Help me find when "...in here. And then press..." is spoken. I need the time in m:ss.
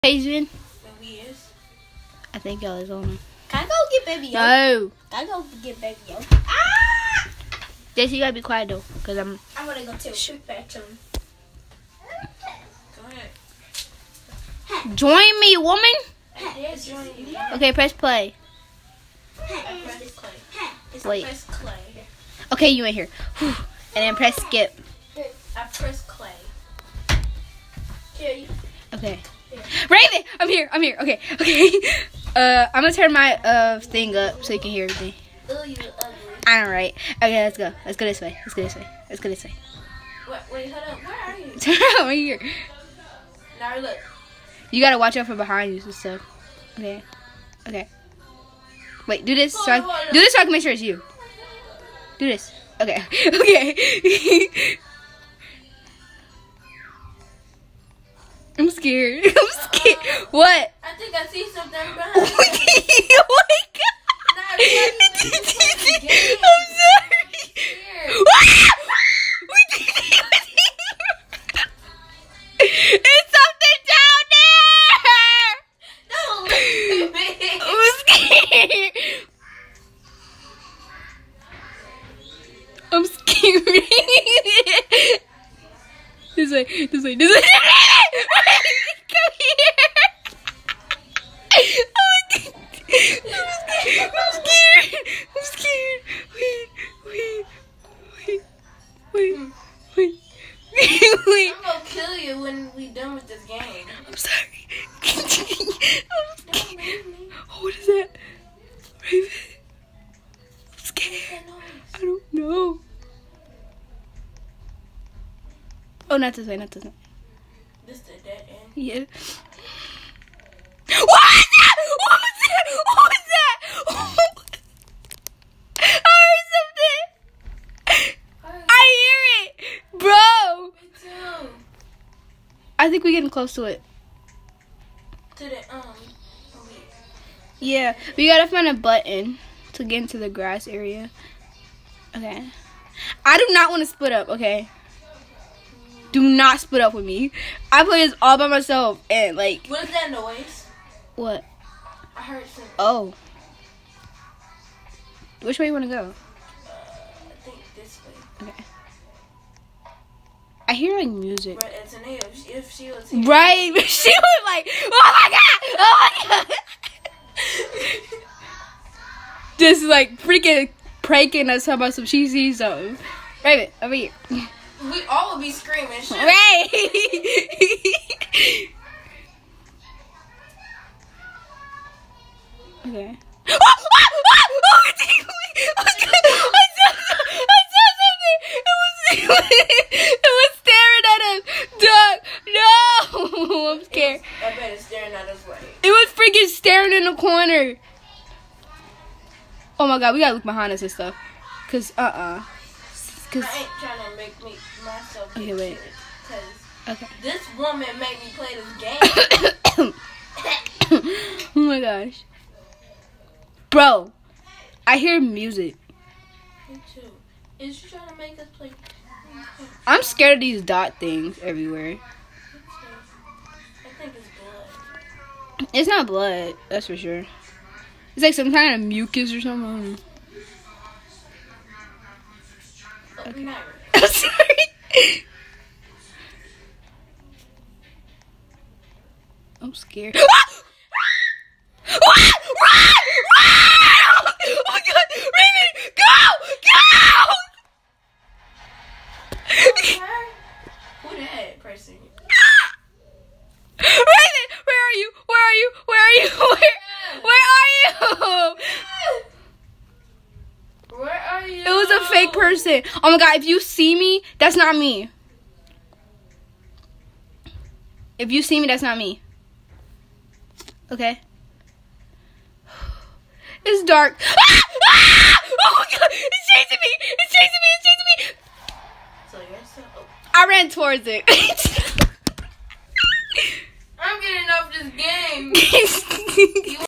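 0:22.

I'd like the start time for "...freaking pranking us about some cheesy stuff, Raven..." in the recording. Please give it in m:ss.
2:50.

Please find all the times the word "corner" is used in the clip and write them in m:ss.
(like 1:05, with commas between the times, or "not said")
3:17.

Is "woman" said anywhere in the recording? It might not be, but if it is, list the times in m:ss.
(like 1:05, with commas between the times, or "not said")
0:15, 3:27.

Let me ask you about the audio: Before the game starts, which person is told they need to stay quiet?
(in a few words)
Jesse.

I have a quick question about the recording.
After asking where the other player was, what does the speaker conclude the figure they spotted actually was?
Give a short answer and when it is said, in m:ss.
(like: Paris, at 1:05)
A fake person, at 4:22.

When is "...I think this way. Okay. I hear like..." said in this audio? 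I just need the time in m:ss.
2:37.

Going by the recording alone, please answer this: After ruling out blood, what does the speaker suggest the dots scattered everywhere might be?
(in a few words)
Mucus.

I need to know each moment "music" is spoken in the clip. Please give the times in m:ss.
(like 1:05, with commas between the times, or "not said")
2:41, 3:35.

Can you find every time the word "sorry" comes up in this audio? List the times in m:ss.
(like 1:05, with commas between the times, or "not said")
1:06, 1:44, 3:54.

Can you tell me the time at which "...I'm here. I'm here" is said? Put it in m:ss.
0:30.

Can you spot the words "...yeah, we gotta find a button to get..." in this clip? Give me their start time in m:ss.
2:17.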